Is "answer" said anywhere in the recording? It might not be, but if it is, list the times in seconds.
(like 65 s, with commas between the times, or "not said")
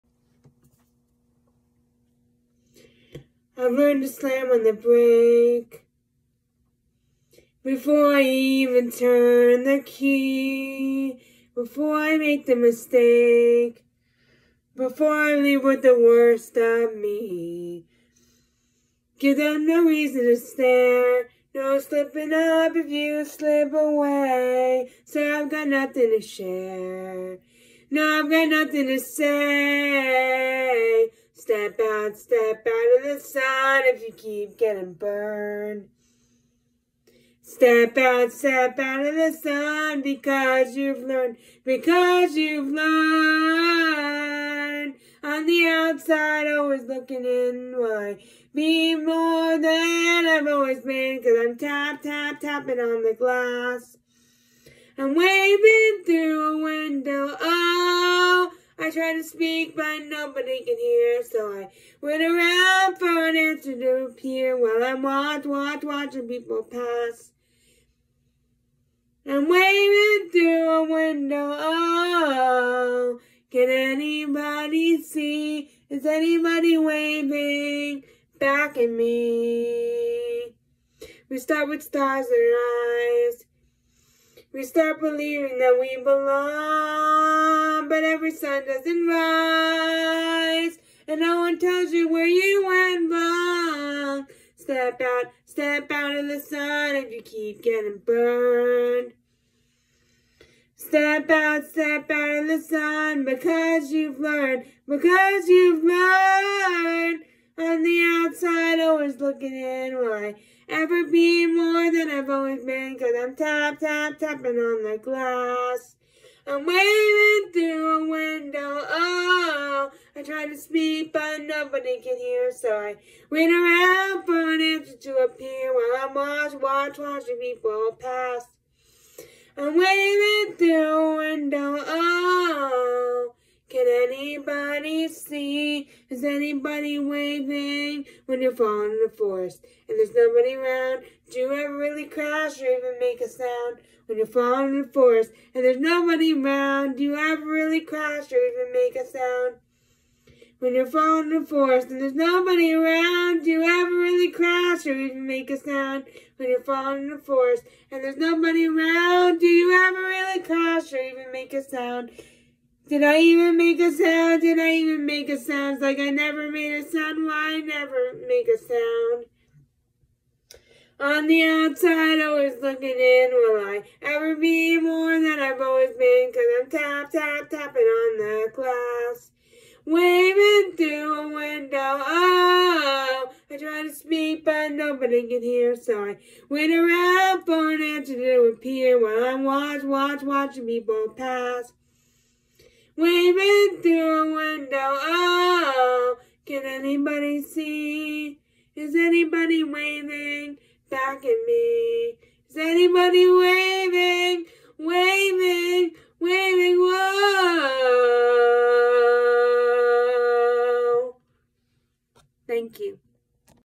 63 s, 124 s, 187 s.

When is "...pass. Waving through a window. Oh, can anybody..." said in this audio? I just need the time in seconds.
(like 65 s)
191 s.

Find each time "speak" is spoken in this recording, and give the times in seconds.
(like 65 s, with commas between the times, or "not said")
59 s, 120 s, 183 s.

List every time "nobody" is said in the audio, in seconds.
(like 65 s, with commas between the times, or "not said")
60 s, 121 s, 140 s, 145 s, 152 s, 158 s, 184 s.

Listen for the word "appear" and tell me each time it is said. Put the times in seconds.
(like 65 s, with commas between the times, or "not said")
64 s, 125 s, 188 s.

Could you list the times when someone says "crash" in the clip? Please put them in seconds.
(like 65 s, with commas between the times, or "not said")
142 s, 147 s, 154 s, 160 s.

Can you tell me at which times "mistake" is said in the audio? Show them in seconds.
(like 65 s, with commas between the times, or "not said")
12 s.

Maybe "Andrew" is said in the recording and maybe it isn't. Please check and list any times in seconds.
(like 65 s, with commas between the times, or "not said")
not said.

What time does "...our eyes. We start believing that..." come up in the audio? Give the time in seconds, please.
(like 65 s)
82 s.